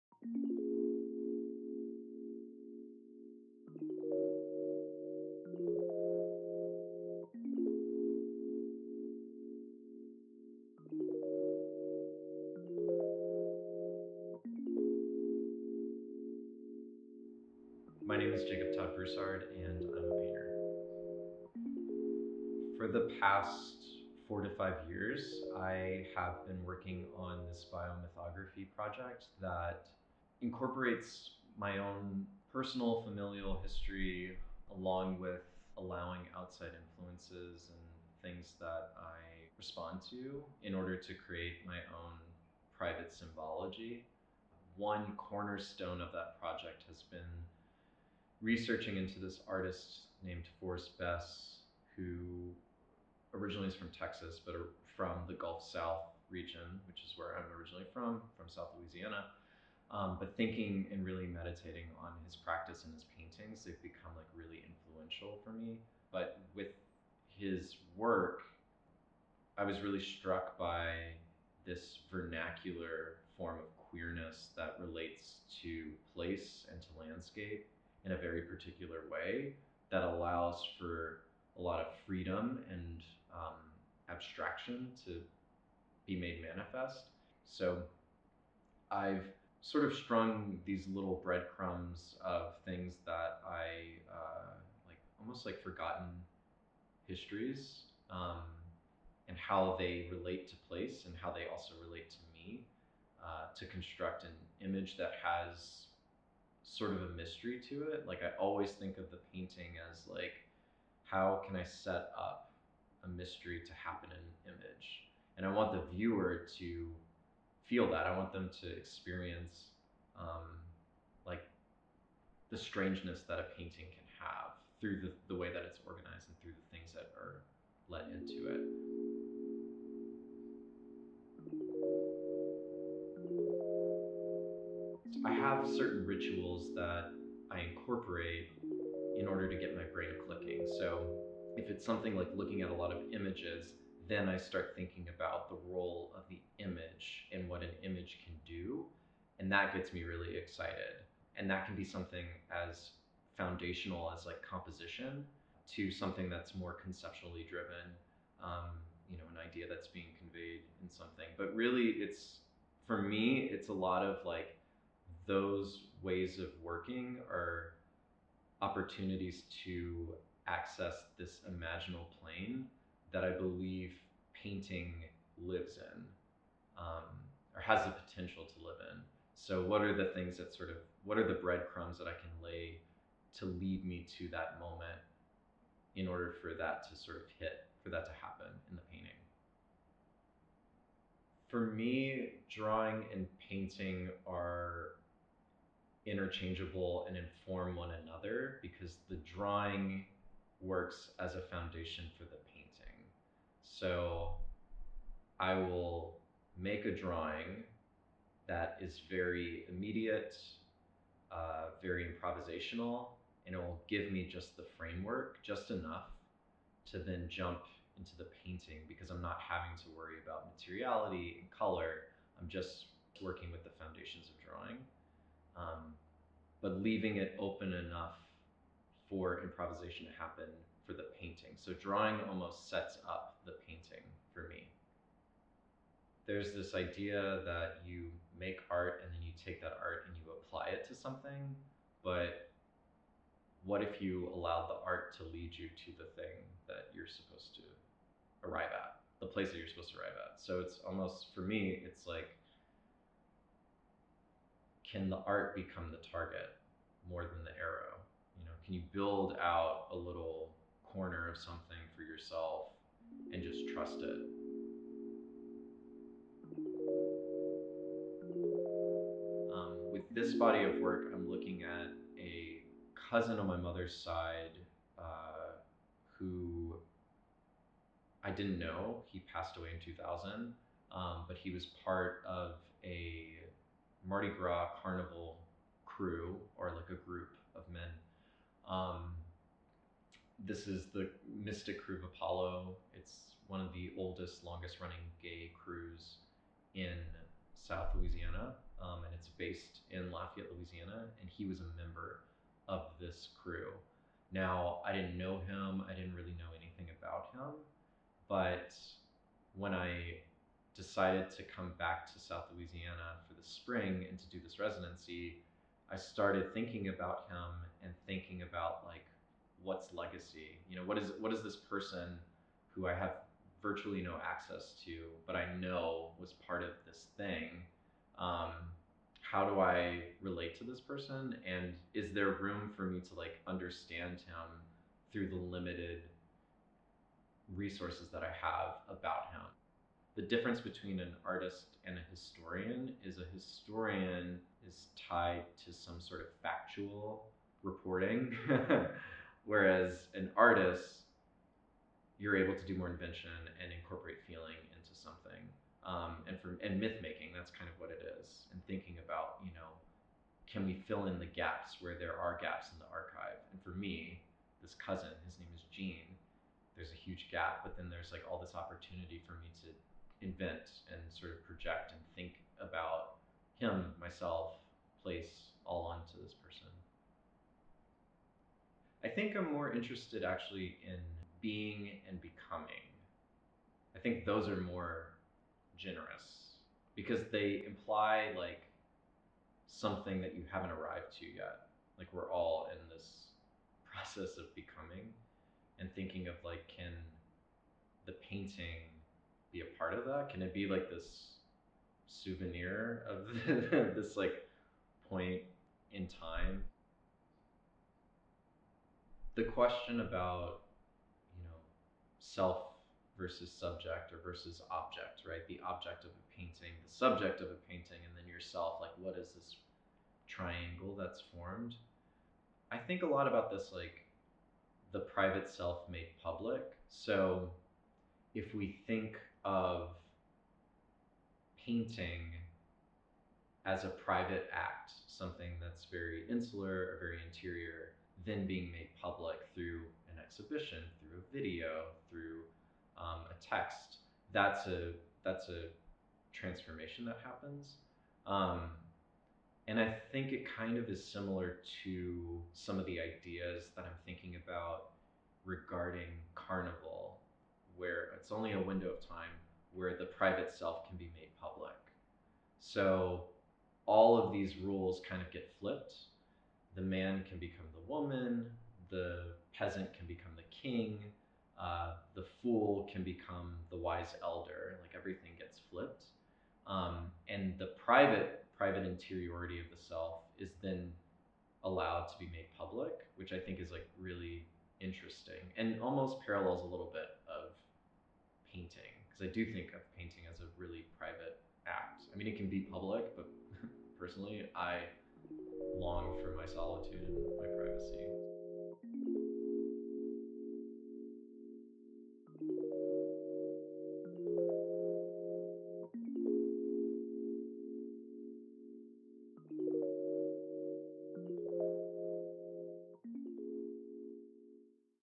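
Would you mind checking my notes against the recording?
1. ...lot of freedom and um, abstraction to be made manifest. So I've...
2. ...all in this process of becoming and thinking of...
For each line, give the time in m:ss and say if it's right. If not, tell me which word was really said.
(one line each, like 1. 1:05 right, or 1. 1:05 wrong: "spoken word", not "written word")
1. 1:21 right
2. 6:32 right.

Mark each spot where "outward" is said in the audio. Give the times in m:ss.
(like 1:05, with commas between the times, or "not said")
not said.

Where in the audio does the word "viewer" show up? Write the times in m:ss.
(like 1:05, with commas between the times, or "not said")
1:55.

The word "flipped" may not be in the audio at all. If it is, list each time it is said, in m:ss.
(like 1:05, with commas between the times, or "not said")
7:45, 7:55.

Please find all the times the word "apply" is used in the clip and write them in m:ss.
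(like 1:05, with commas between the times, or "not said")
4:00.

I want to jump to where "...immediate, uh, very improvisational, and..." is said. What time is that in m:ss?
3:29.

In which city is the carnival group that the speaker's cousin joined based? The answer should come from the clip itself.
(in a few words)
Lafayette, Louisiana.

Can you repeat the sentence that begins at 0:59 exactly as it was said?
Um, but thinking and really meditating on his practice and his paintings, they've become like really influential for me.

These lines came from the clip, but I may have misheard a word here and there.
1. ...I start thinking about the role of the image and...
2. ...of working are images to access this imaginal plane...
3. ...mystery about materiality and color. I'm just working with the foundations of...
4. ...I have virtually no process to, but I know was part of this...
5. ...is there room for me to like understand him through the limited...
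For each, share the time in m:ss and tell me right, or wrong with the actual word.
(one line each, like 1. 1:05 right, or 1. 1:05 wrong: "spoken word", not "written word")
1. 2:24 right
2. 2:46 wrong: "opportunities", not "images"
3. 3:39 wrong: "worry", not "mystery"
4. 5:22 wrong: "access", not "process"
5. 5:31 right.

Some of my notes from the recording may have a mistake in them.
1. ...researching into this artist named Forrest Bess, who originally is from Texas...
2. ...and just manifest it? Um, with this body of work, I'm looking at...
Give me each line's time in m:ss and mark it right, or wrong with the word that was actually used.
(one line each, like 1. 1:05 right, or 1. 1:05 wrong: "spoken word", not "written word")
1. 0:48 right
2. 4:23 wrong: "trust", not "manifest".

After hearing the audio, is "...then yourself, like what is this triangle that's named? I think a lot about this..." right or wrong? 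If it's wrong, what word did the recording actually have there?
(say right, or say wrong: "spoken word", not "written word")
wrong: "formed", not "named".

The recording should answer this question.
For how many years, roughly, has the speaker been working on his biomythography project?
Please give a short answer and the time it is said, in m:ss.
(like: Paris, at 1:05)
4 to 5 years, at 0:24.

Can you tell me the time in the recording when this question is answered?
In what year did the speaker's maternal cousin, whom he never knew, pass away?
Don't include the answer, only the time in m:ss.
4:39.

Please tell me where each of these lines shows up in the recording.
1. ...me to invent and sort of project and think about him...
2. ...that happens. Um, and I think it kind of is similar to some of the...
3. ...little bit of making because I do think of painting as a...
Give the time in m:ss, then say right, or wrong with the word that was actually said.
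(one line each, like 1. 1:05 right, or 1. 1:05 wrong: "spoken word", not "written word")
1. 6:09 right
2. 7:27 right
3. 8:06 wrong: "painting", not "making".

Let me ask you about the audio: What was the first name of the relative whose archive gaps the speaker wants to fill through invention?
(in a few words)
Gene.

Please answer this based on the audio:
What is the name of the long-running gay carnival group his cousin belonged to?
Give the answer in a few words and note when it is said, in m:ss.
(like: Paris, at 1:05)
Mystic Krewe of Apollo, at 4:51.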